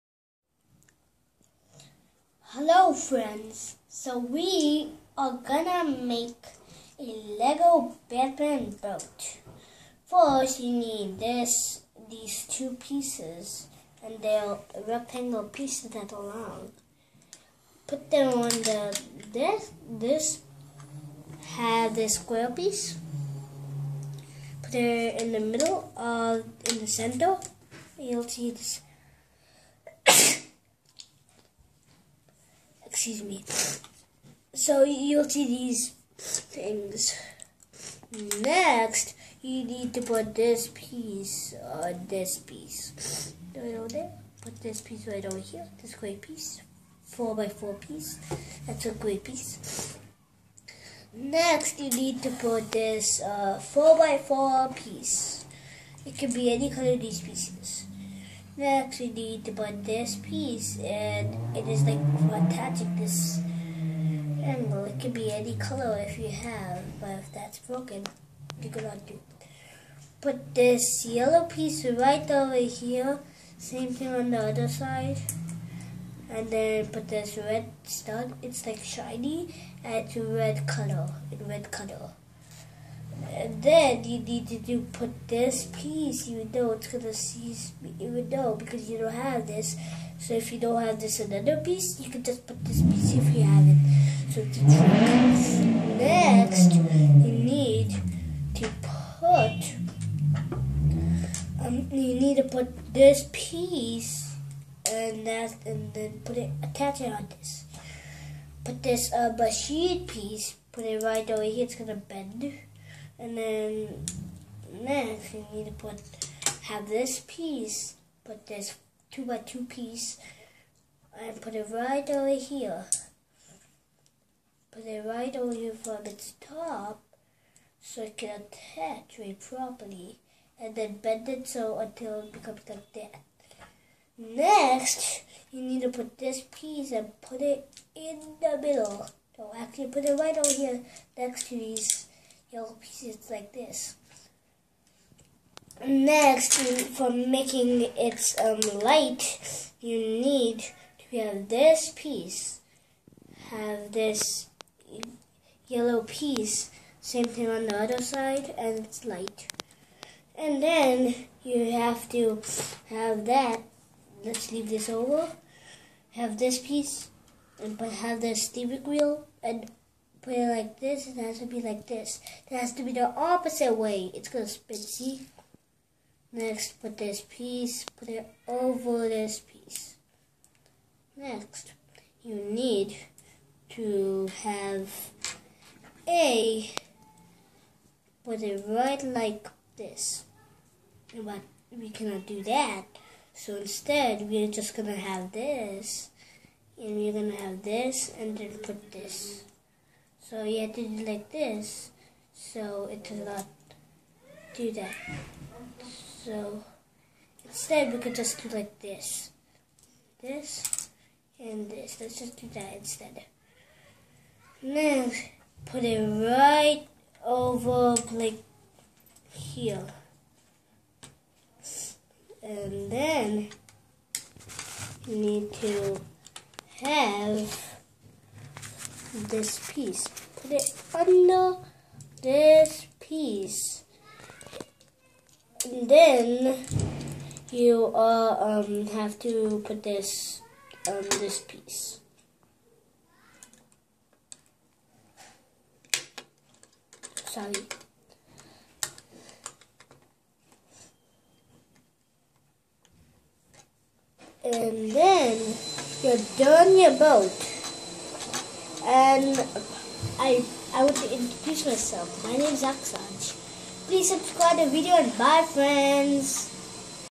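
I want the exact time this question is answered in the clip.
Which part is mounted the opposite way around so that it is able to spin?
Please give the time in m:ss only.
2:48.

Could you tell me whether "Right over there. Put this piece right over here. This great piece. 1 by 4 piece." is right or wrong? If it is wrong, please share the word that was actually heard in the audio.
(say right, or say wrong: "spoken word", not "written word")
wrong: "4", not "1".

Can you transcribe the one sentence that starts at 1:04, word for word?
It could be any color if you have, but if that's broken, you cannot do.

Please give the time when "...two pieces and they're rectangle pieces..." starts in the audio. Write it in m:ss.
0:12.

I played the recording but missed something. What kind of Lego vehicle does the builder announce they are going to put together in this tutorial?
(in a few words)
Lego Batman boat.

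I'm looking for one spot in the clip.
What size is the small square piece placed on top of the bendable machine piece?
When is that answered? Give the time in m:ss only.
1:59.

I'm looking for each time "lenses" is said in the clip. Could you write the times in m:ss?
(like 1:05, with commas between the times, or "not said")
not said.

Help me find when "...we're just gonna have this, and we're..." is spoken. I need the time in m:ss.
3:14.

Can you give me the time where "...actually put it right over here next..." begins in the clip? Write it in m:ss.
2:19.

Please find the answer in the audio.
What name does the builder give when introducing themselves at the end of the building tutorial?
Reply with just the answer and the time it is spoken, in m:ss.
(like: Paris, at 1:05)
Aksanj, at 4:22.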